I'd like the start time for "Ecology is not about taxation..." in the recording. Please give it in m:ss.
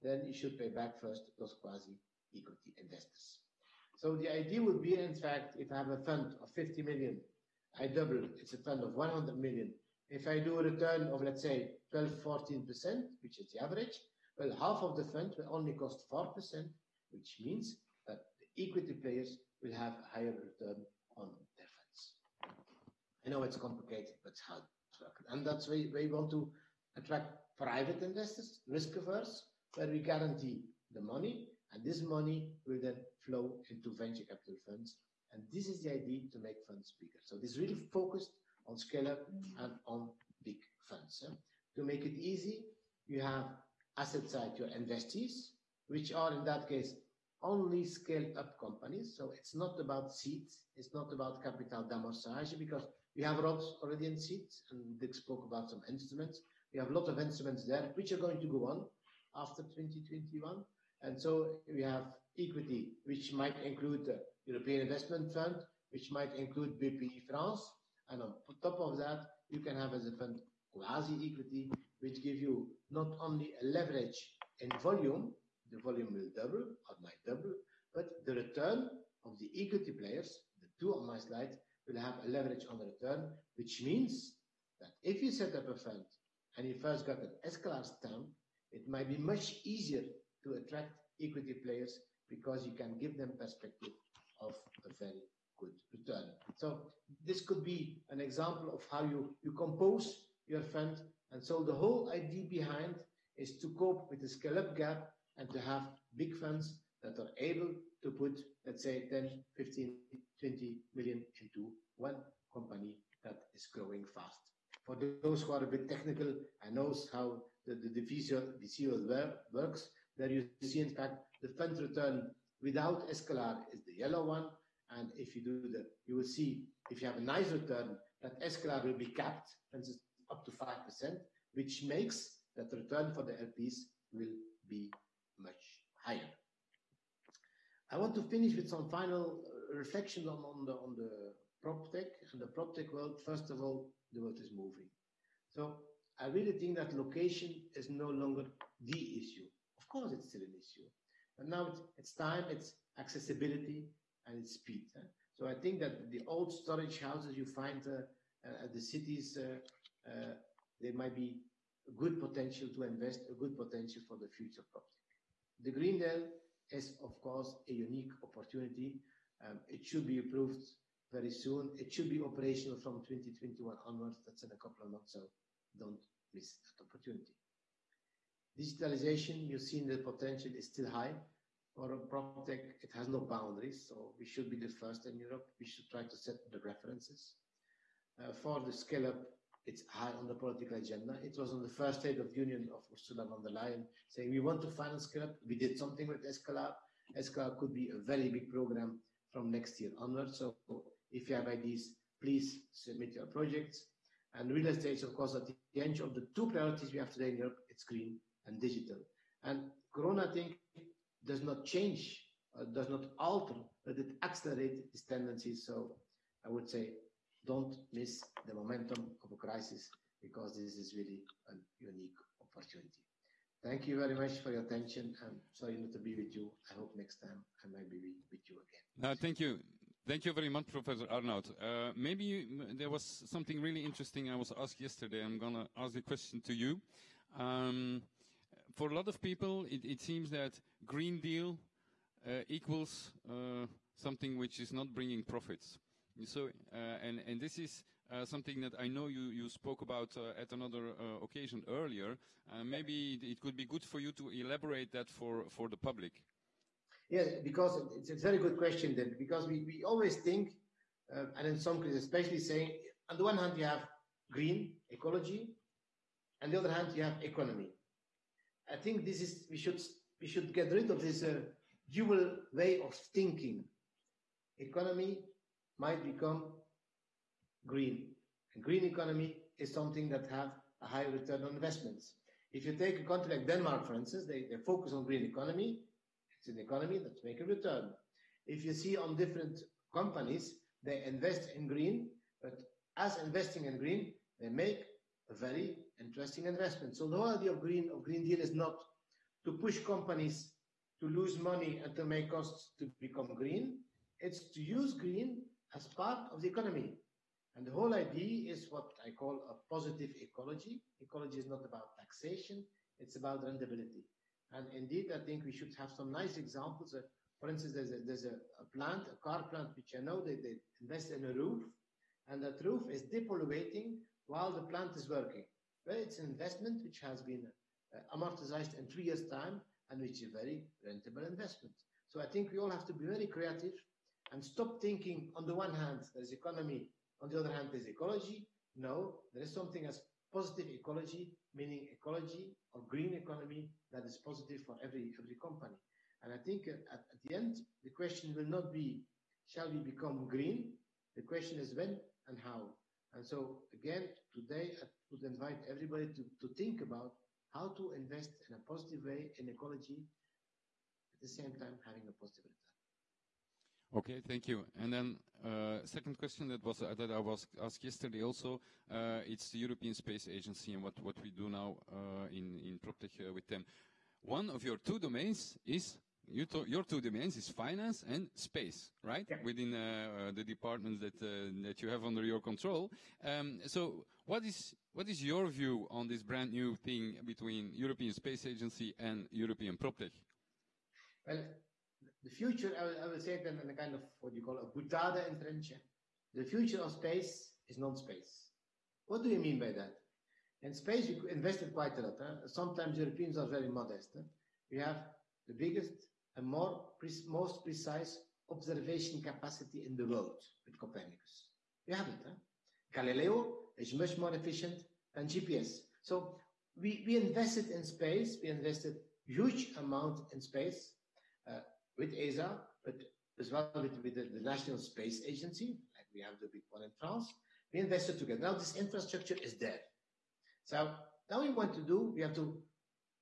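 5:11.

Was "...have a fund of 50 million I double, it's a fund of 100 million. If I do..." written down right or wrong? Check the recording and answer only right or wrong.
right.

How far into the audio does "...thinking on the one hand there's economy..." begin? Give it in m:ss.
5:34.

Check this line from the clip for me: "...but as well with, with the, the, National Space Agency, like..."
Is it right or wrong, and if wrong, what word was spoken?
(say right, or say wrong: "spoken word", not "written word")
right.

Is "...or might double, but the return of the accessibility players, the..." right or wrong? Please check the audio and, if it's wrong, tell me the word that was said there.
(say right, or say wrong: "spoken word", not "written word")
wrong: "equity", not "accessibility".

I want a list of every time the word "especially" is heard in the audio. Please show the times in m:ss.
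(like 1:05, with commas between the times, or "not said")
4:22.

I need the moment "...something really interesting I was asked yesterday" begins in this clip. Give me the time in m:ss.
3:53.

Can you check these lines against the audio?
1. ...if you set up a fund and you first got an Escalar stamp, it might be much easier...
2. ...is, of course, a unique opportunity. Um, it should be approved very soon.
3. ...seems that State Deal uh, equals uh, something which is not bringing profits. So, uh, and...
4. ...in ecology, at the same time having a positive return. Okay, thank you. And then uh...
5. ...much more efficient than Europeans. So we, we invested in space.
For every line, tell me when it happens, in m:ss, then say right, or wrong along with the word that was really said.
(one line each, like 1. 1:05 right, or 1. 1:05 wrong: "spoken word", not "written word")
1. 1:25 right
2. 2:46 right
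3. 4:00 wrong: "Green", not "State"
4. 5:59 right
5. 6:53 wrong: "GPS", not "Europeans".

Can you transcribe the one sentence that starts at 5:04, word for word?
It's to use green as part of the economy.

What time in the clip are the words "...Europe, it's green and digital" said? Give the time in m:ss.
3:27.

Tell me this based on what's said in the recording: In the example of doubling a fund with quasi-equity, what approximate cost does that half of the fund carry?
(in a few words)
4%.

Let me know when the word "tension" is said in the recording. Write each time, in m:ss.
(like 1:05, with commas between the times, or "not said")
not said.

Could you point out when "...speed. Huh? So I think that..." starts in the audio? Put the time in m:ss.
2:34.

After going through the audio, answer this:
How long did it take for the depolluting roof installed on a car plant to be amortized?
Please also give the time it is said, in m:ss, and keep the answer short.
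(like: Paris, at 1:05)
3 years, at 5:28.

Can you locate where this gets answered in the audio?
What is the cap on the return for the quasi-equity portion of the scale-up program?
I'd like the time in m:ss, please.
2:10.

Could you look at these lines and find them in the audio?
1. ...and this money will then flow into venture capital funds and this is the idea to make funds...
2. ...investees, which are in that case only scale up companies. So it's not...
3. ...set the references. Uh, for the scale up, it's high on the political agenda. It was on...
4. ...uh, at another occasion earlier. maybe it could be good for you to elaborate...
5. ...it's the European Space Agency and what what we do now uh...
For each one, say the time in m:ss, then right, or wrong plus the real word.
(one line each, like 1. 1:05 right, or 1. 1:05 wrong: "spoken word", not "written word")
1. 0:31 right
2. 0:44 right
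3. 3:06 right
4. 4:10 right
5. 6:09 right.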